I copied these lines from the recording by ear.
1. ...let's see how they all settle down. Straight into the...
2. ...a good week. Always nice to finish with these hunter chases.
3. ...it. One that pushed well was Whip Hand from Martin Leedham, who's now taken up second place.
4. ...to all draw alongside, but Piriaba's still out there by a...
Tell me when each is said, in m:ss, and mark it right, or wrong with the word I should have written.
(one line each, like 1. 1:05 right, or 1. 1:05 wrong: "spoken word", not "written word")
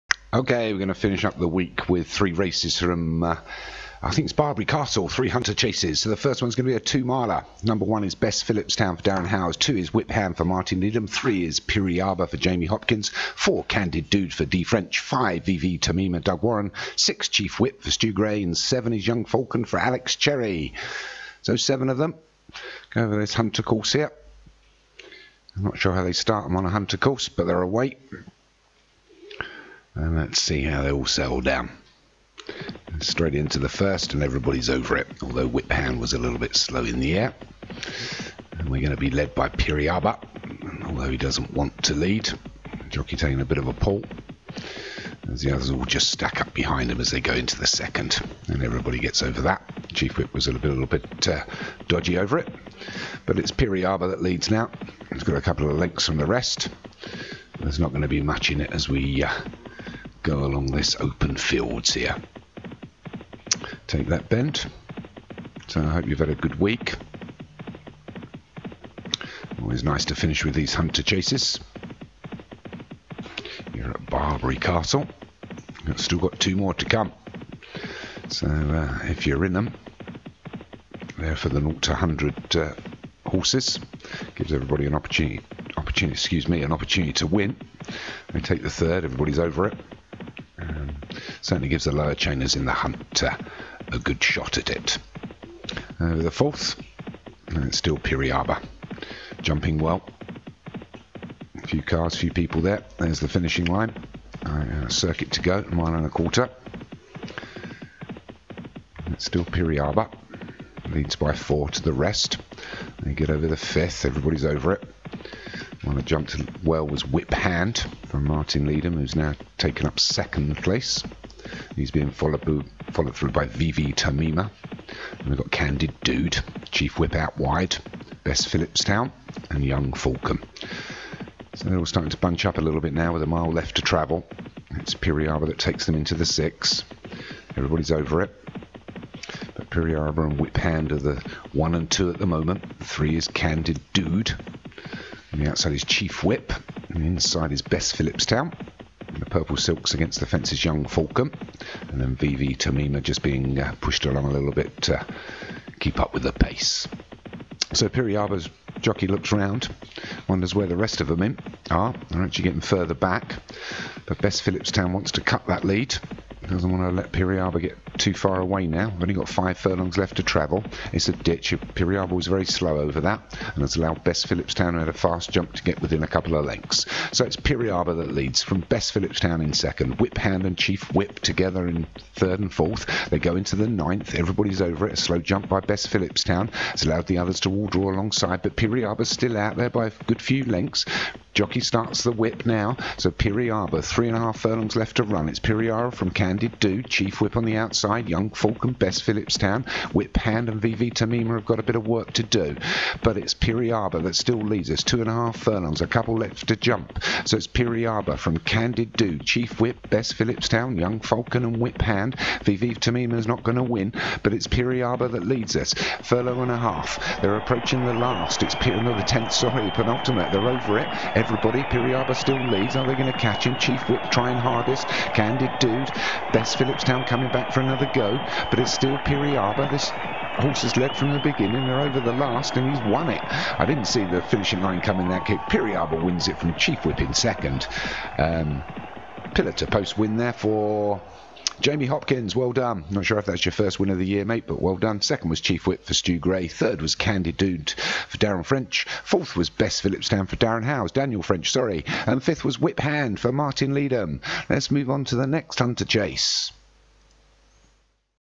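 1. 0:30 right
2. 1:06 right
3. 1:54 wrong: "jumped", not "pushed"
4. 3:07 right.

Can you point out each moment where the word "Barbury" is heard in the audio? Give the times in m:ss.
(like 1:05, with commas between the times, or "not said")
0:04, 1:14.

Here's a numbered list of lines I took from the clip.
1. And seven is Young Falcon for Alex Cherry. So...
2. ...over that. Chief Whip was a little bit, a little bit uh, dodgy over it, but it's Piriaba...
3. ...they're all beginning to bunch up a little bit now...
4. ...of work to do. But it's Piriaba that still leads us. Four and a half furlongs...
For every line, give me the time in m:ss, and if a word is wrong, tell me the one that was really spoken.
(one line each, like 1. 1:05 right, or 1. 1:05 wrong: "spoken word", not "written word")
1. 0:18 right
2. 0:49 right
3. 2:11 wrong: "starting", not "beginning"
4. 3:21 wrong: "Two", not "Four".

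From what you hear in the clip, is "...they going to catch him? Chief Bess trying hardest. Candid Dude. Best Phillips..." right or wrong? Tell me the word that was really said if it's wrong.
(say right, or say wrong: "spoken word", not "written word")
wrong: "Whip", not "Bess".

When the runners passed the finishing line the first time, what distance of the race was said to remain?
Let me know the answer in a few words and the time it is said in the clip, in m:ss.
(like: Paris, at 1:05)
Mile and a quarter, at 1:45.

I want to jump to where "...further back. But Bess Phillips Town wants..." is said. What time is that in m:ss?
2:42.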